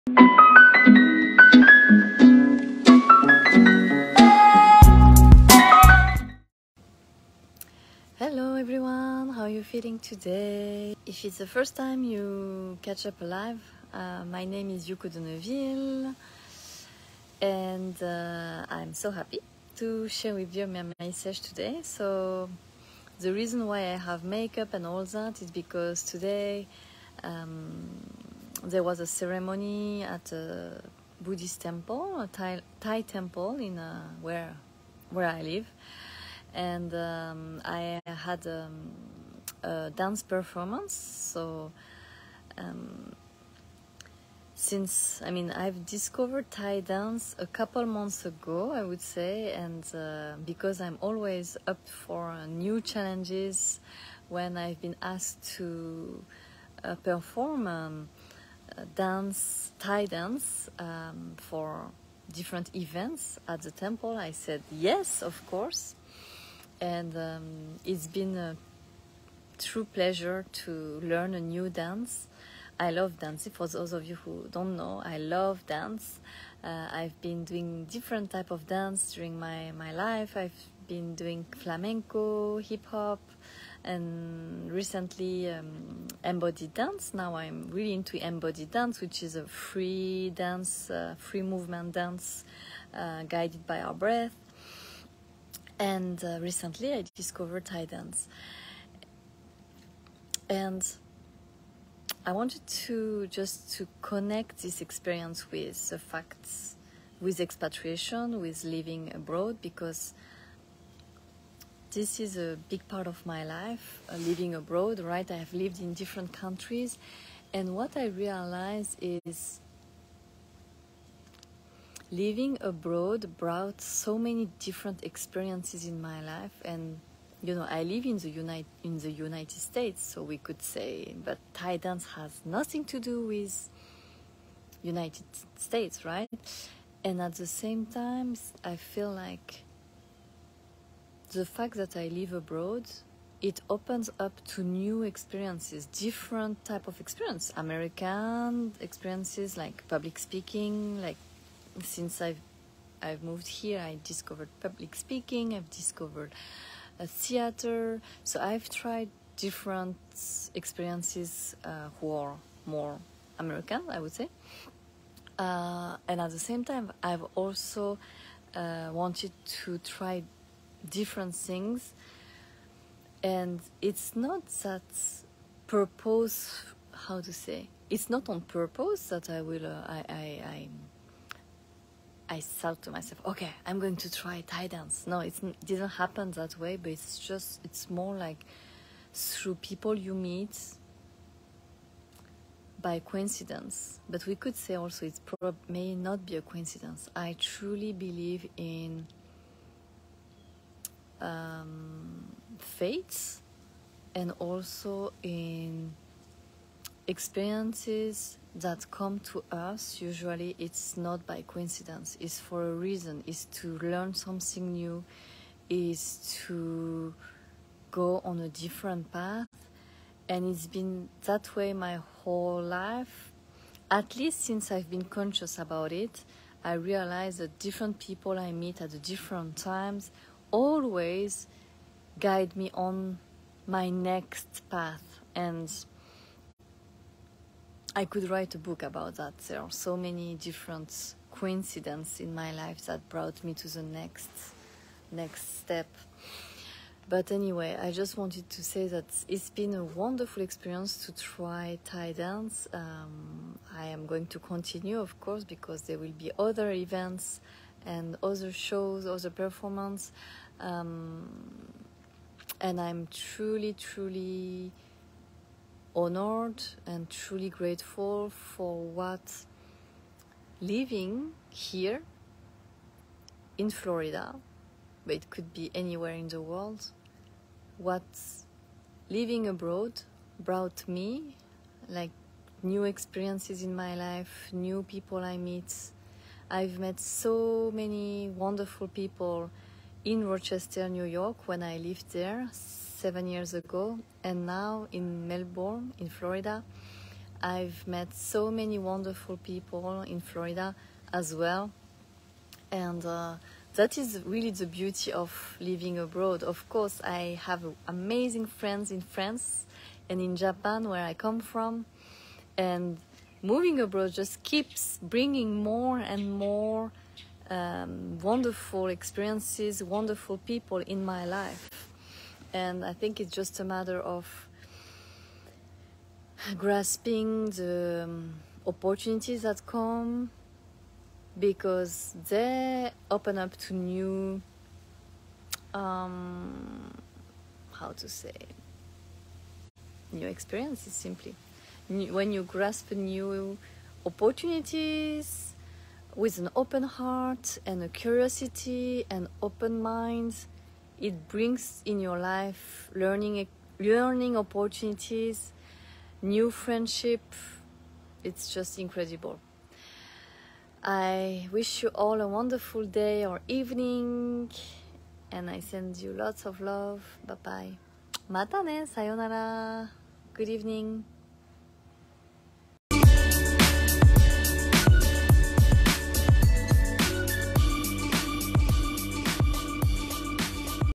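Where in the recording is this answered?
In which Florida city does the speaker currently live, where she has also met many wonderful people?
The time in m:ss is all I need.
4:55.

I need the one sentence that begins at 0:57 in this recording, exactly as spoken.
Um, dance, Thai dance um, for different events at the temple?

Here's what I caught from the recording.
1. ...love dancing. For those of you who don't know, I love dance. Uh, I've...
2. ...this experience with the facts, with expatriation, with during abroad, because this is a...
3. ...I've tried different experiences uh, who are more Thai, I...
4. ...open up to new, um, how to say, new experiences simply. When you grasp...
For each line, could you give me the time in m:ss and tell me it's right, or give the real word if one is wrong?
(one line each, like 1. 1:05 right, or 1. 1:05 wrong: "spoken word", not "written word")
1. 1:12 right
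2. 1:44 wrong: "living", not "during"
3. 2:38 wrong: "American", not "Thai"
4. 5:33 right.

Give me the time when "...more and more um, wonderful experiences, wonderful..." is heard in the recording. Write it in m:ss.
5:15.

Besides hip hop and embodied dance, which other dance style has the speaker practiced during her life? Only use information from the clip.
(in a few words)
Flamenco.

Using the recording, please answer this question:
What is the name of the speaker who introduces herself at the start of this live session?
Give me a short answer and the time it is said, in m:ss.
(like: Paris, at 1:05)
Yuko Deneuville, at 0:14.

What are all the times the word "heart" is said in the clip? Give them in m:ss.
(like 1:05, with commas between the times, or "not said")
5:46.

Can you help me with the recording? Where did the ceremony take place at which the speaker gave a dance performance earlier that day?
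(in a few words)
Buddhist temple.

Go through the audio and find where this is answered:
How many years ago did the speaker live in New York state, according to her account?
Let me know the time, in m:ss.
4:52.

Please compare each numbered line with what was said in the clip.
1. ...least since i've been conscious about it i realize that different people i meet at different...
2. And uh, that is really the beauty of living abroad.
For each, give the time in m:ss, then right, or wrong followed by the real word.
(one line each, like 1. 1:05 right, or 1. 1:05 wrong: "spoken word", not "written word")
1. 3:44 right
2. 5:02 right.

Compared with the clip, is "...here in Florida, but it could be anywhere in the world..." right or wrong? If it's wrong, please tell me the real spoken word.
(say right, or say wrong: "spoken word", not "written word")
right.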